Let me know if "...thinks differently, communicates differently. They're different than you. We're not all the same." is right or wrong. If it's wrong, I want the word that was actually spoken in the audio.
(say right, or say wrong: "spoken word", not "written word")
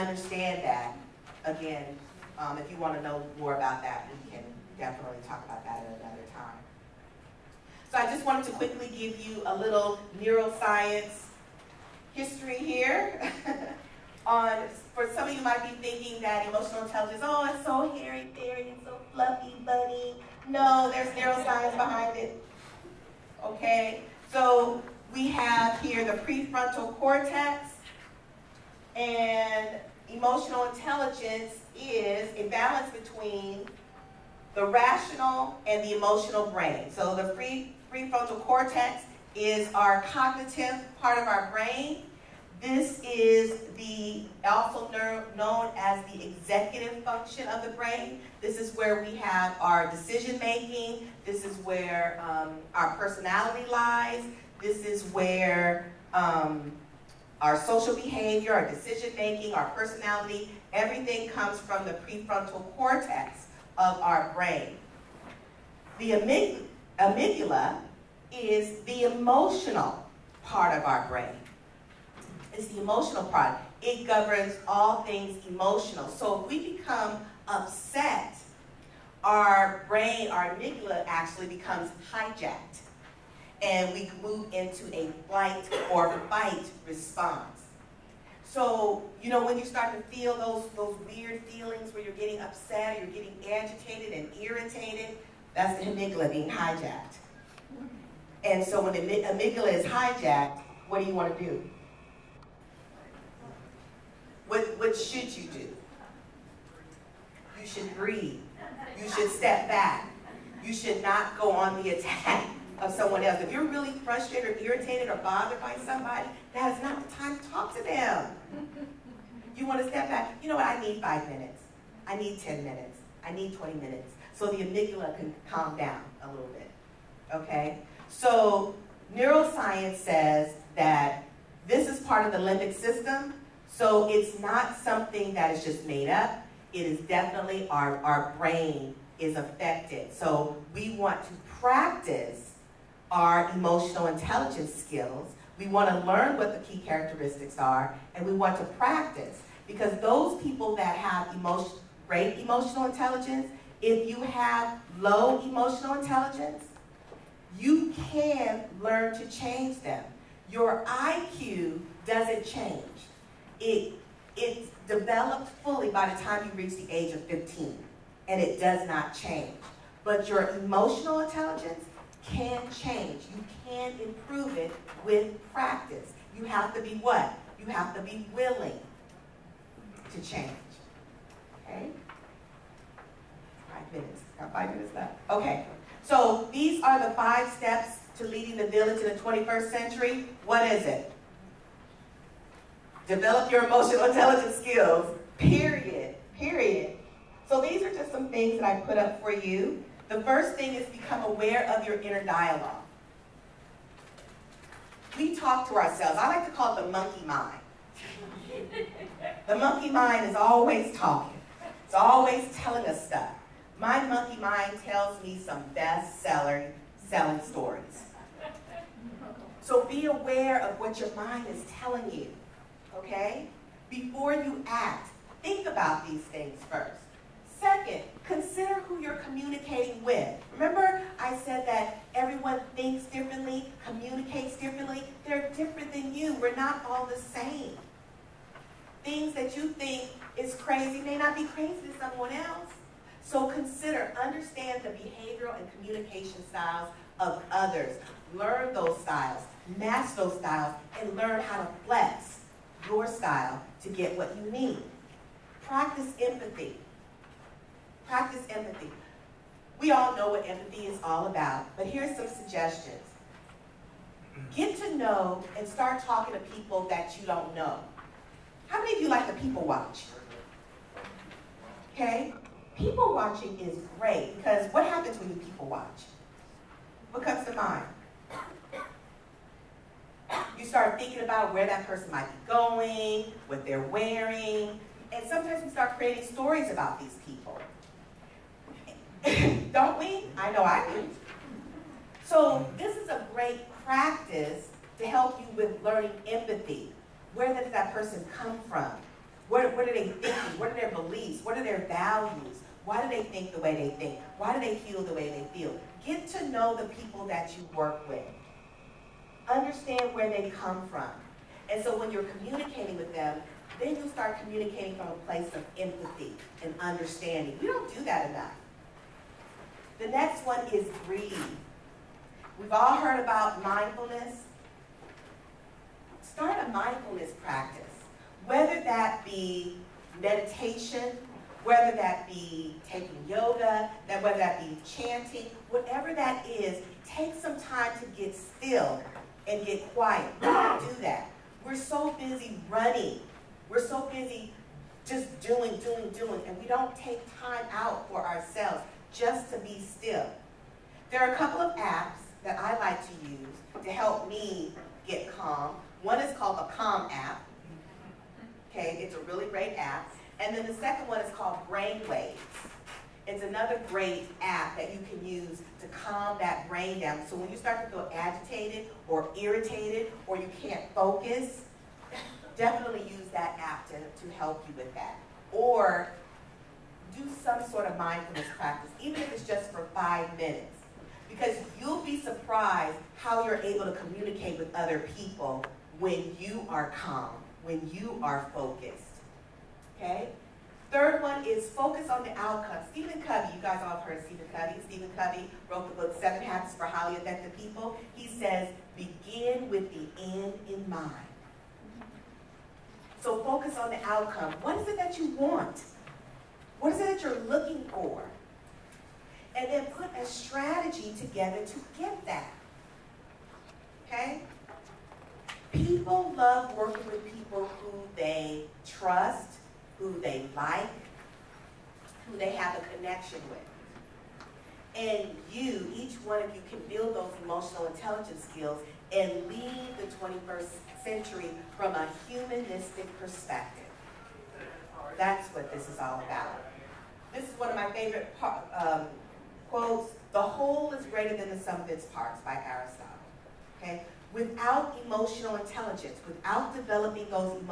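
right.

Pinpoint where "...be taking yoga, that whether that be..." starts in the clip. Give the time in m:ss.
5:32.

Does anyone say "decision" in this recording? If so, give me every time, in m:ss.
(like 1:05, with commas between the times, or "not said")
0:49, 0:58.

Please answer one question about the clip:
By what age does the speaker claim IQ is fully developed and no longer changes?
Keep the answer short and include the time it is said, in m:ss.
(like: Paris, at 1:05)
15, at 2:47.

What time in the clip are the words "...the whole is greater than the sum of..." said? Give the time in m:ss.
7:20.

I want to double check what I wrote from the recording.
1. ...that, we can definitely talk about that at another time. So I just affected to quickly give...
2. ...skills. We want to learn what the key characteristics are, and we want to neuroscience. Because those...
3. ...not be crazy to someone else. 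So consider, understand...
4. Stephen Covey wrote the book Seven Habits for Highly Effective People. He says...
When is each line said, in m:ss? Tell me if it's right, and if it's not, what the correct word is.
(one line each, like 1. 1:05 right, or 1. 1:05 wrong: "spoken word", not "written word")
1. 0:03 wrong: "wanted", not "affected"
2. 2:24 wrong: "practice", not "neuroscience"
3. 4:01 right
4. 6:34 right.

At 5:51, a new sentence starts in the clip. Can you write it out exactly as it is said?
There are a couple of apps that I like to use to help me get calm.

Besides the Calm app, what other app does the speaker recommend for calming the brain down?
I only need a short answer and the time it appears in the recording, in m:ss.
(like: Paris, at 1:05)
Brainwaves, at 6:01.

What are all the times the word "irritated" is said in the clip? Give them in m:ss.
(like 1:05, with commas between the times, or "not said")
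1:34, 1:54, 6:09.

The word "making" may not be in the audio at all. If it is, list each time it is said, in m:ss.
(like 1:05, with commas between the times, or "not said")
0:50, 0:59.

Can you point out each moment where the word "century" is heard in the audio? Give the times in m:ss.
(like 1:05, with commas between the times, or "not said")
3:09, 7:11.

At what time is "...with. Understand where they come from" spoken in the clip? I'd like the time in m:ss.
5:08.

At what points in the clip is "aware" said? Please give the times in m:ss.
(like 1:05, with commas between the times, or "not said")
3:21, 3:40.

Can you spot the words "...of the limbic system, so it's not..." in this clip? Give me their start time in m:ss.
2:12.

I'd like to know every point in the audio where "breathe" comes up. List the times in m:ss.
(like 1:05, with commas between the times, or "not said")
1:47, 5:21.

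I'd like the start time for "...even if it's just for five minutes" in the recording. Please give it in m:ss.
6:19.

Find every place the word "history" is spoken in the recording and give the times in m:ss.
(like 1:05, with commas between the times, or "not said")
0:12.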